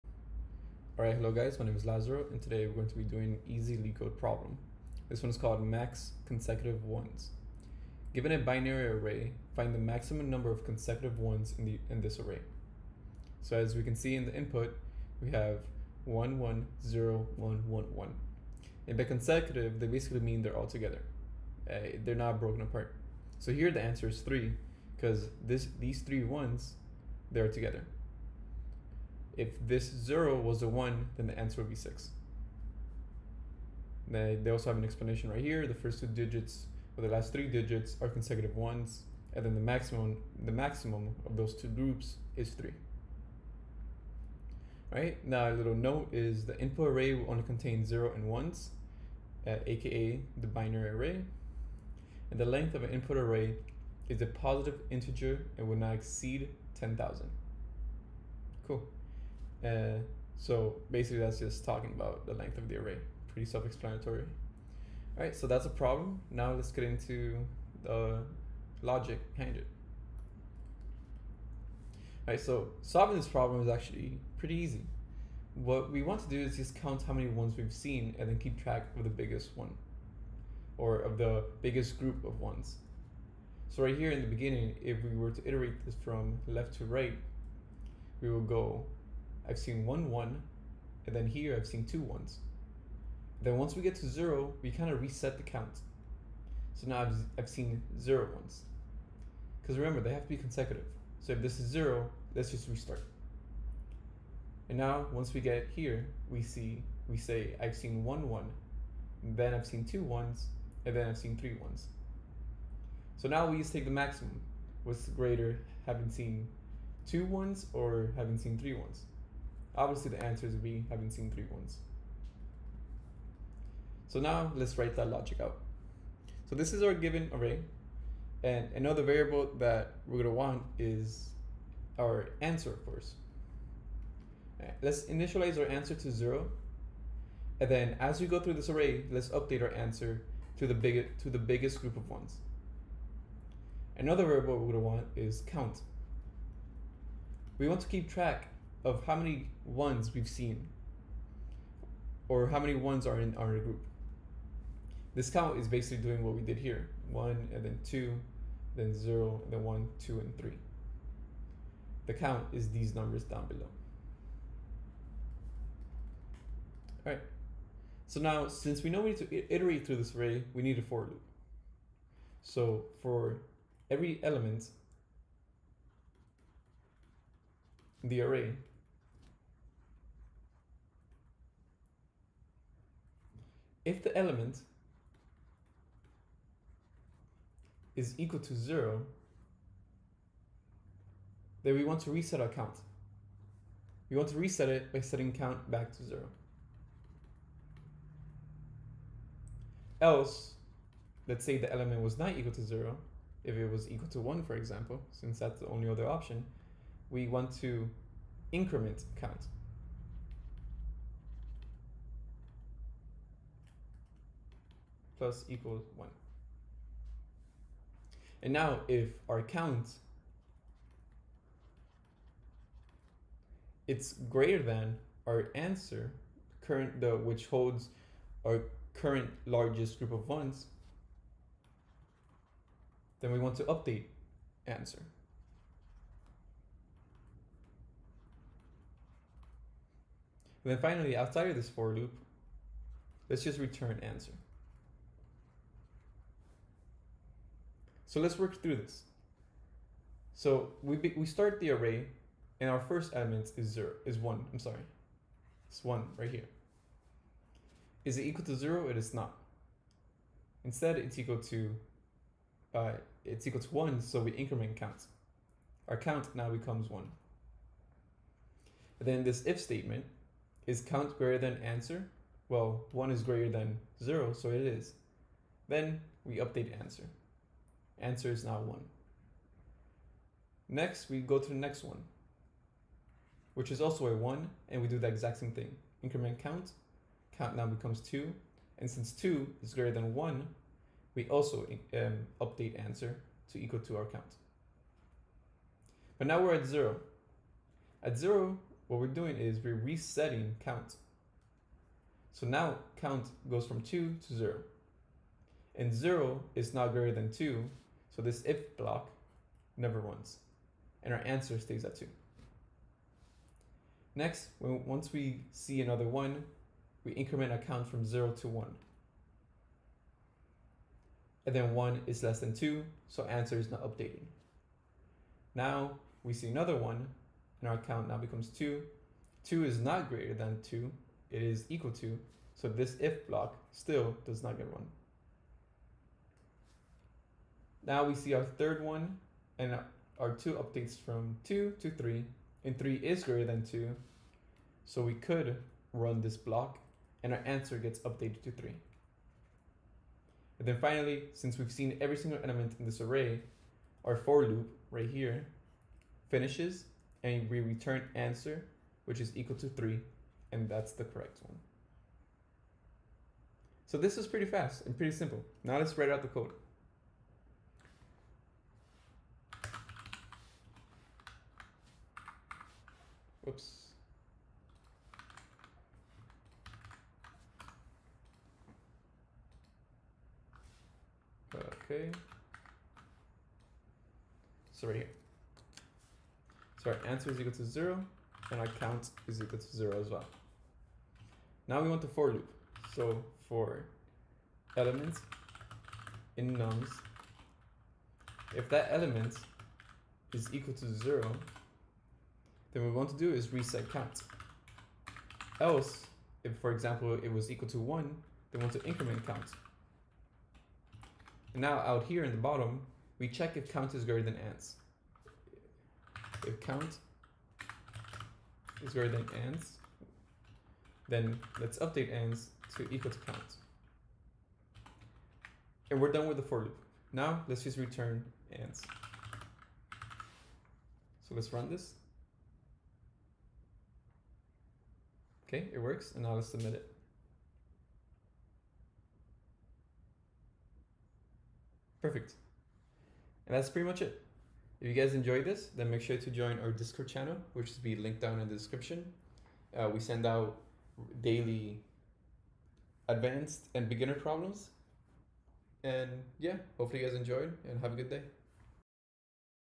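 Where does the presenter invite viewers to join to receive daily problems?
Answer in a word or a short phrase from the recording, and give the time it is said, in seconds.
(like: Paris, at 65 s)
Discord channel, at 446 s.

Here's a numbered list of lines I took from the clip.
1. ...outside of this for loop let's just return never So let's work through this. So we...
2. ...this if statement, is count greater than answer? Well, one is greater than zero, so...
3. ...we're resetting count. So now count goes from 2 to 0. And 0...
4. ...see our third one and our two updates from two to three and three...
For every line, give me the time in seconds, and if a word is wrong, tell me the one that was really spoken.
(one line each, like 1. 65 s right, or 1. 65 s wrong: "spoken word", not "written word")
1. 241 s wrong: "answer", not "never"
2. 269 s right
3. 299 s right
4. 338 s right.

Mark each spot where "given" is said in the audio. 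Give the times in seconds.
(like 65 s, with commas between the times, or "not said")
8 s, 126 s.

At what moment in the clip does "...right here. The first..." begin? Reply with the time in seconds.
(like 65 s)
35 s.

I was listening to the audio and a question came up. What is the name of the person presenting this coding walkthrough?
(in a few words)
Lazaro.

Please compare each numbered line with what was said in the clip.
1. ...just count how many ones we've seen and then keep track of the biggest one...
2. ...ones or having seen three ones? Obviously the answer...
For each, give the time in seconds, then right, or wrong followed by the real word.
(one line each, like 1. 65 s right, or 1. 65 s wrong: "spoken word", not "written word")
1. 76 s right
2. 117 s right.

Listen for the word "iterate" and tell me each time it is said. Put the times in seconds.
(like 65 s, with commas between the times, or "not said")
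85 s, 169 s.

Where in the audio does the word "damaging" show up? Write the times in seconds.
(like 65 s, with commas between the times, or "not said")
not said.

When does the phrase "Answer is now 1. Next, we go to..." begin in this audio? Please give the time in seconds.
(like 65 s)
278 s.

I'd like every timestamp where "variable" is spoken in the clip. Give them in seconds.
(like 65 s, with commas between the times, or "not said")
129 s, 144 s.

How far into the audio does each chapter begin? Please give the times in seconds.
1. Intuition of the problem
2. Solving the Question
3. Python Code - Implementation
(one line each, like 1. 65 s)
1. 70 s
2. 125 s
3. 385 s.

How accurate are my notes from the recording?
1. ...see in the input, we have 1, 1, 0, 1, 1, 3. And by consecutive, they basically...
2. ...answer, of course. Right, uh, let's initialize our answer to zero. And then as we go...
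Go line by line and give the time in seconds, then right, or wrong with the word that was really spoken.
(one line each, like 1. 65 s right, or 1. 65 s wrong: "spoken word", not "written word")
1. 13 s wrong: "1", not "3"
2. 132 s right.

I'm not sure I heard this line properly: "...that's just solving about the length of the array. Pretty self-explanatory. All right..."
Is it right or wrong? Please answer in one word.
wrong.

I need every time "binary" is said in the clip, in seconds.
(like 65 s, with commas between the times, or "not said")
8 s, 50 s.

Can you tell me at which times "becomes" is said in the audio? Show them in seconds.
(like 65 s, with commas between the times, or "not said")
266 s, 287 s, 328 s.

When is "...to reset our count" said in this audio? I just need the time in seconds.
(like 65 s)
192 s.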